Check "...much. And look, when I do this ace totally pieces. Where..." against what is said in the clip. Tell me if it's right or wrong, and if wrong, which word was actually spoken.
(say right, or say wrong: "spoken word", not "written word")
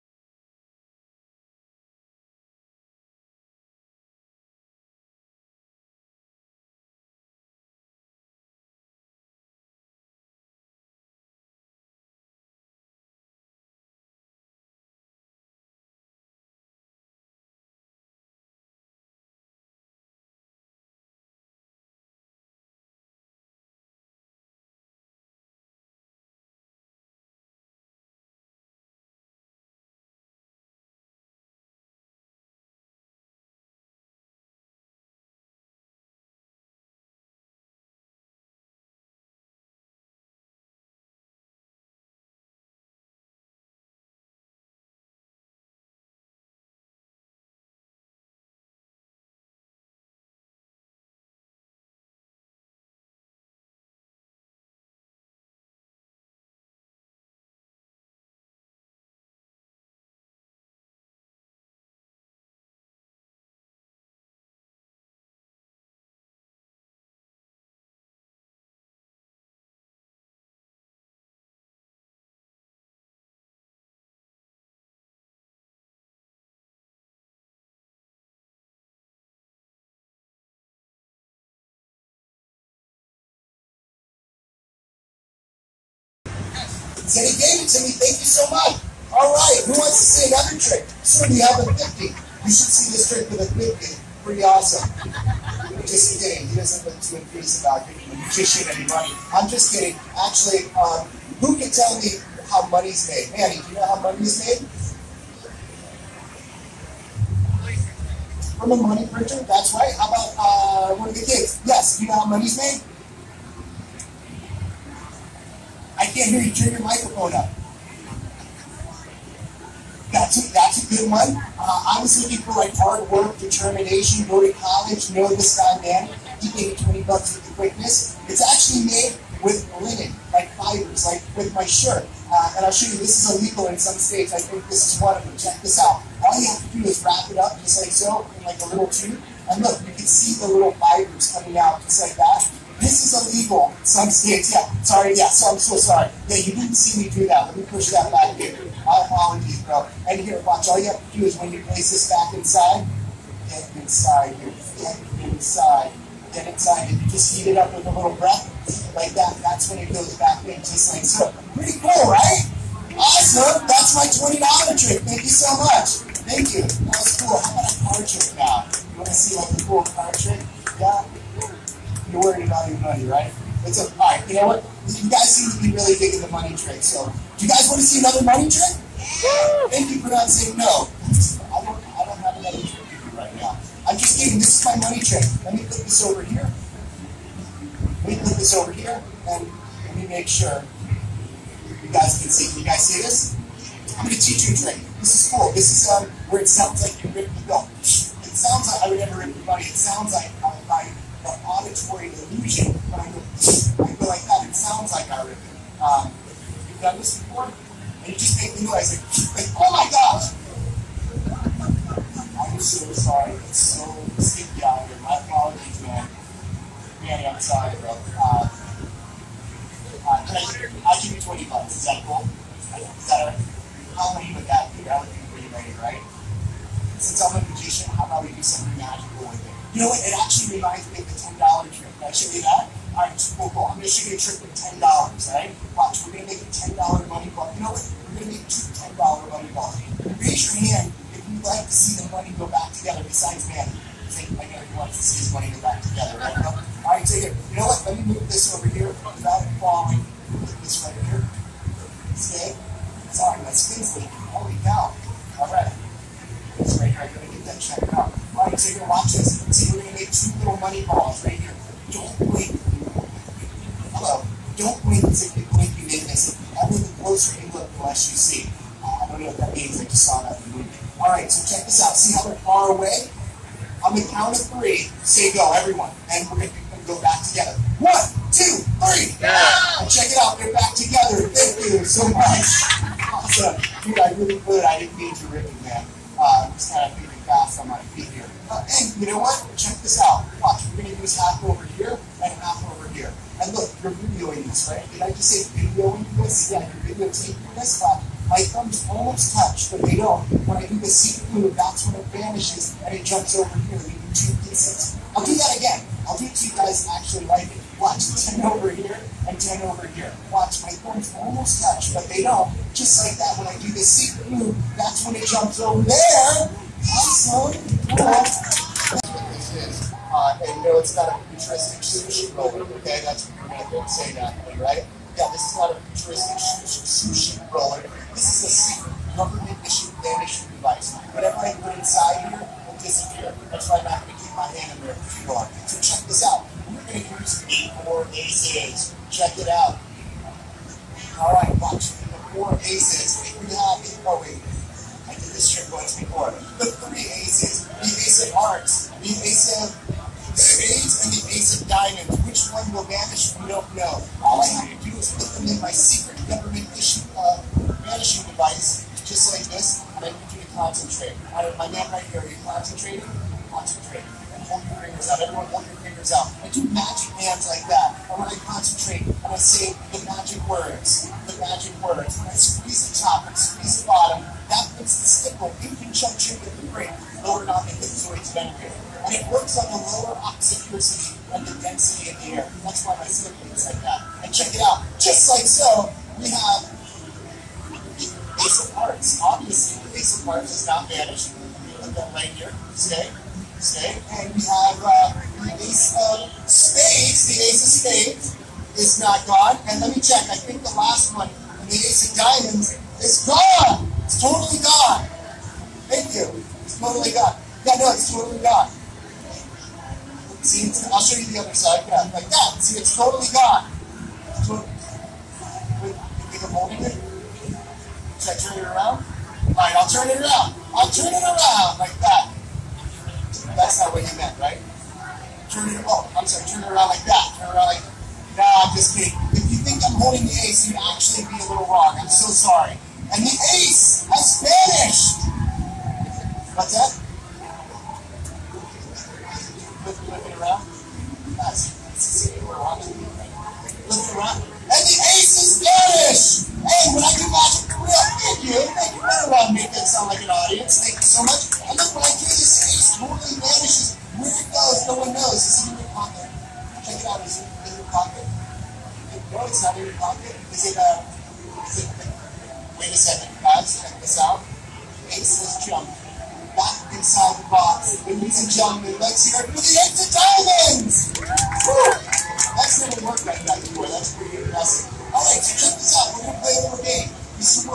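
wrong: "vanishes", not "pieces".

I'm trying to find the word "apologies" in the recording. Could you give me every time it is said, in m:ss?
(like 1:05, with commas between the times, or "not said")
2:29, 3:35.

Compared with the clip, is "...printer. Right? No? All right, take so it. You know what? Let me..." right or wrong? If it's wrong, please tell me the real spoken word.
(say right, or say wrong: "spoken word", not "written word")
wrong: "together", not "printer".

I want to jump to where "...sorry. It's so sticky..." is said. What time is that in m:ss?
3:32.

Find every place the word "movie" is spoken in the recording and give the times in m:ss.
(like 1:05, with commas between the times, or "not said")
4:30.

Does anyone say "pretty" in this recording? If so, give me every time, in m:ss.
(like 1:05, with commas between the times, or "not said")
1:34, 2:41, 3:45, 7:54.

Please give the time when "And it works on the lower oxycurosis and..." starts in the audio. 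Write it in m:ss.
6:19.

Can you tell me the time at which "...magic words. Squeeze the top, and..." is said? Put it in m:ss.
6:11.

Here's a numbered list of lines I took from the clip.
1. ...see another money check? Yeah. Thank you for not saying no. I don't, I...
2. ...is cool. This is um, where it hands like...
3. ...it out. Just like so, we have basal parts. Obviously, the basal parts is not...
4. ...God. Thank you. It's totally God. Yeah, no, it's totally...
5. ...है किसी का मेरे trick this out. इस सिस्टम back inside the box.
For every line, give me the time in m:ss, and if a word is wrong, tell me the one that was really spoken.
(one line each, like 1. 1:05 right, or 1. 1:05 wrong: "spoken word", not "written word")
1. 2:57 wrong: "trick", not "check"
2. 3:15 wrong: "sounds", not "hands"
3. 6:24 right
4. 6:44 right
5. 7:40 wrong: "check", not "trick".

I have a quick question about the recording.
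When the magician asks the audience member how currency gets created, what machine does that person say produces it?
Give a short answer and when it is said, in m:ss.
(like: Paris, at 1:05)
A money printer, at 1:48.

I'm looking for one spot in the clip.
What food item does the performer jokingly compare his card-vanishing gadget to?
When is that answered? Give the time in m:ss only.
5:21.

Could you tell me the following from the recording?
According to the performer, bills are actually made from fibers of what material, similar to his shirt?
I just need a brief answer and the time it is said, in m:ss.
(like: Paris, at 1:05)
Linen, at 2:09.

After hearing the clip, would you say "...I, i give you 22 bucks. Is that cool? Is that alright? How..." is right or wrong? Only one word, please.
wrong.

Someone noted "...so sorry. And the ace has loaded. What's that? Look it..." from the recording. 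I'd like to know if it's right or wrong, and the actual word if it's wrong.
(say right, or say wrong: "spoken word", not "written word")
wrong: "vanished", not "loaded".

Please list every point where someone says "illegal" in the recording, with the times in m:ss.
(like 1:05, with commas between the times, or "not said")
2:13, 2:23.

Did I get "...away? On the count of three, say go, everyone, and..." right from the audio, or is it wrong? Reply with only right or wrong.
right.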